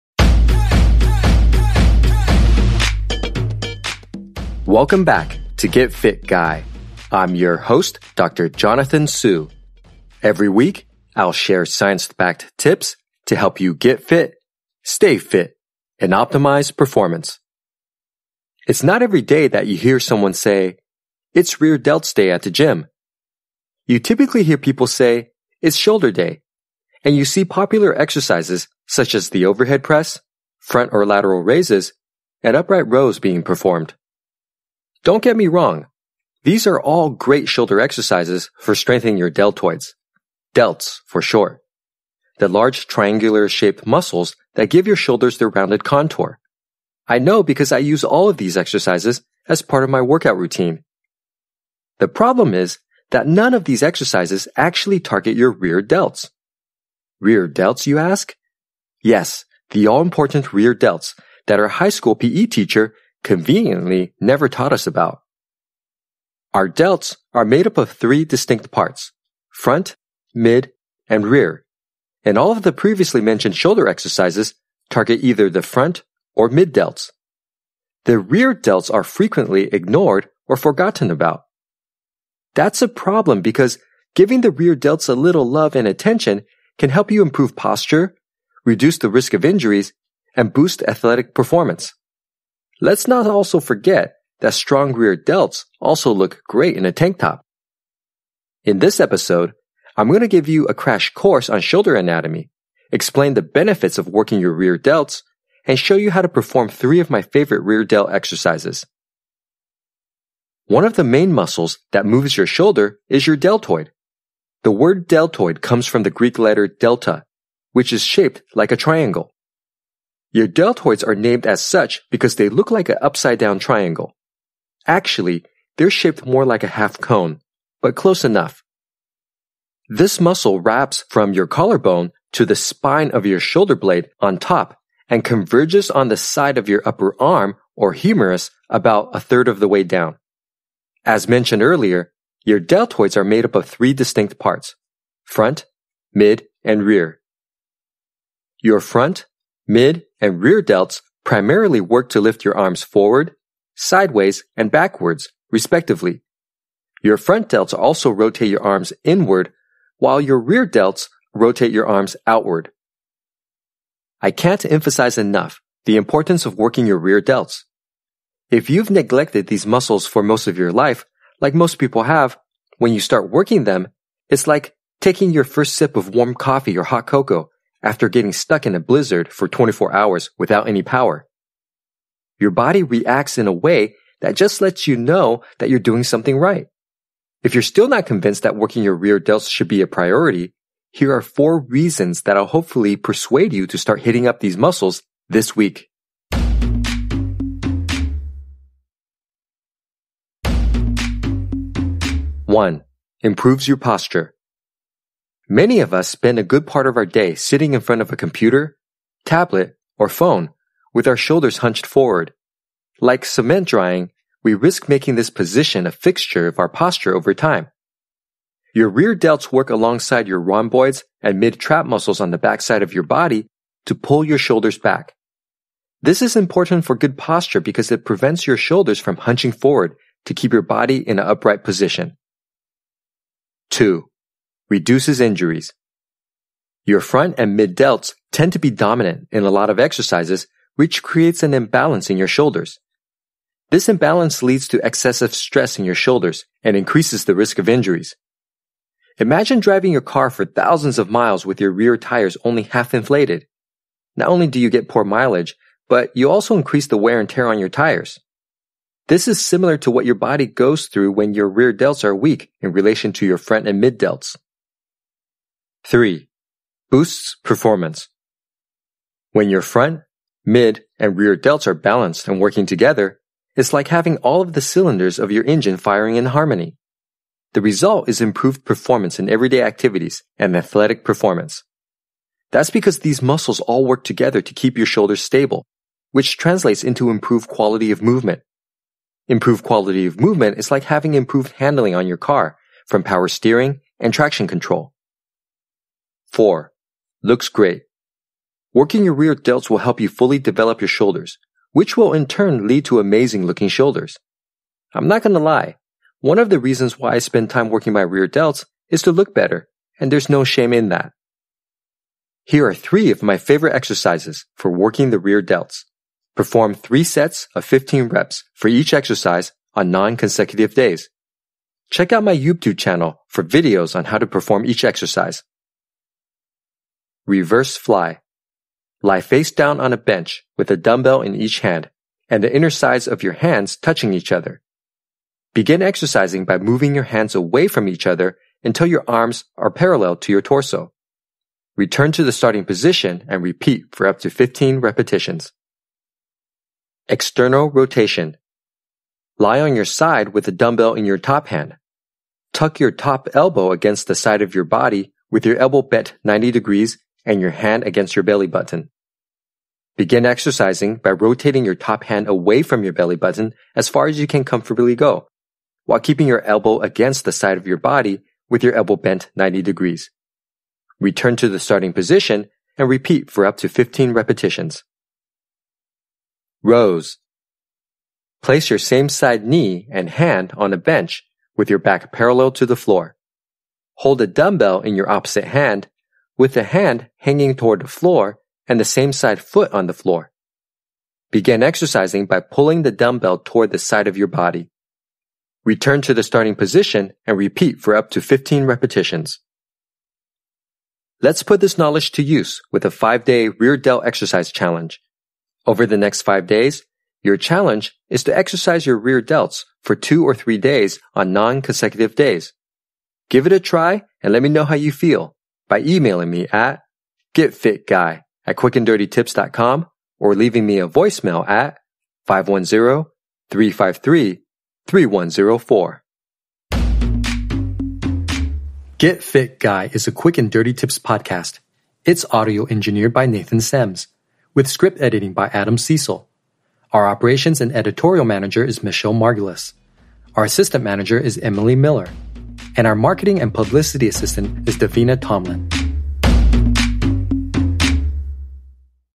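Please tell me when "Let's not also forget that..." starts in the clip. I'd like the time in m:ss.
1:32.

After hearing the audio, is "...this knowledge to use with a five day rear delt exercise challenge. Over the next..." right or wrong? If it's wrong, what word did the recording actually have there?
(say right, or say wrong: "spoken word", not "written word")
right.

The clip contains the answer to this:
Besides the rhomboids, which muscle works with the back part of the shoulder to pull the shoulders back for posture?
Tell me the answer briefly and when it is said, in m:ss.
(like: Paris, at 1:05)
mid-trap, at 3:41.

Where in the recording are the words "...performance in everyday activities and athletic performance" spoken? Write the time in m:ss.
4:38.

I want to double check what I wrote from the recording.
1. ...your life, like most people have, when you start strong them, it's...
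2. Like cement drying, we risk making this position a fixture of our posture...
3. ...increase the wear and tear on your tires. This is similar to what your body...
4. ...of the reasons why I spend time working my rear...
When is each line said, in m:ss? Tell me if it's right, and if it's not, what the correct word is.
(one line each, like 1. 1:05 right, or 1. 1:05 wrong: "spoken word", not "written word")
1. 2:50 wrong: "working", not "strong"
2. 3:33 right
3. 4:16 right
4. 5:06 right.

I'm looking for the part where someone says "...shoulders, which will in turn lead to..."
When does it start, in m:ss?
5:00.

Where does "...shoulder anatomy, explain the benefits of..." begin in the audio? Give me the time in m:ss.
1:41.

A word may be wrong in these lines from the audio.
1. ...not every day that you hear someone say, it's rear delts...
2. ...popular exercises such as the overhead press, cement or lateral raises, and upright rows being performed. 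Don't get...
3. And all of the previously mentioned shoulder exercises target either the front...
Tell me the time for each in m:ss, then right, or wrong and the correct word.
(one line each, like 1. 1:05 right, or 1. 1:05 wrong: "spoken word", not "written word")
1. 0:18 right
2. 0:27 wrong: "front", not "cement"
3. 1:12 right.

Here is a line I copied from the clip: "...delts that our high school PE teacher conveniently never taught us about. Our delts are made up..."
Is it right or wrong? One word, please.
right.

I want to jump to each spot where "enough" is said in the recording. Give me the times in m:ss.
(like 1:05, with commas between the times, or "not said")
2:08, 2:45.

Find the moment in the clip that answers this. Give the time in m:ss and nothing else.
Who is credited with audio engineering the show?
7:13.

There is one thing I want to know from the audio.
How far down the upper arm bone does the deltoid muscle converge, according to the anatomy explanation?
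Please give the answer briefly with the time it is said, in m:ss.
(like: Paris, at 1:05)
a third, at 2:19.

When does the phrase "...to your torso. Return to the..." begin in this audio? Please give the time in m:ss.
5:40.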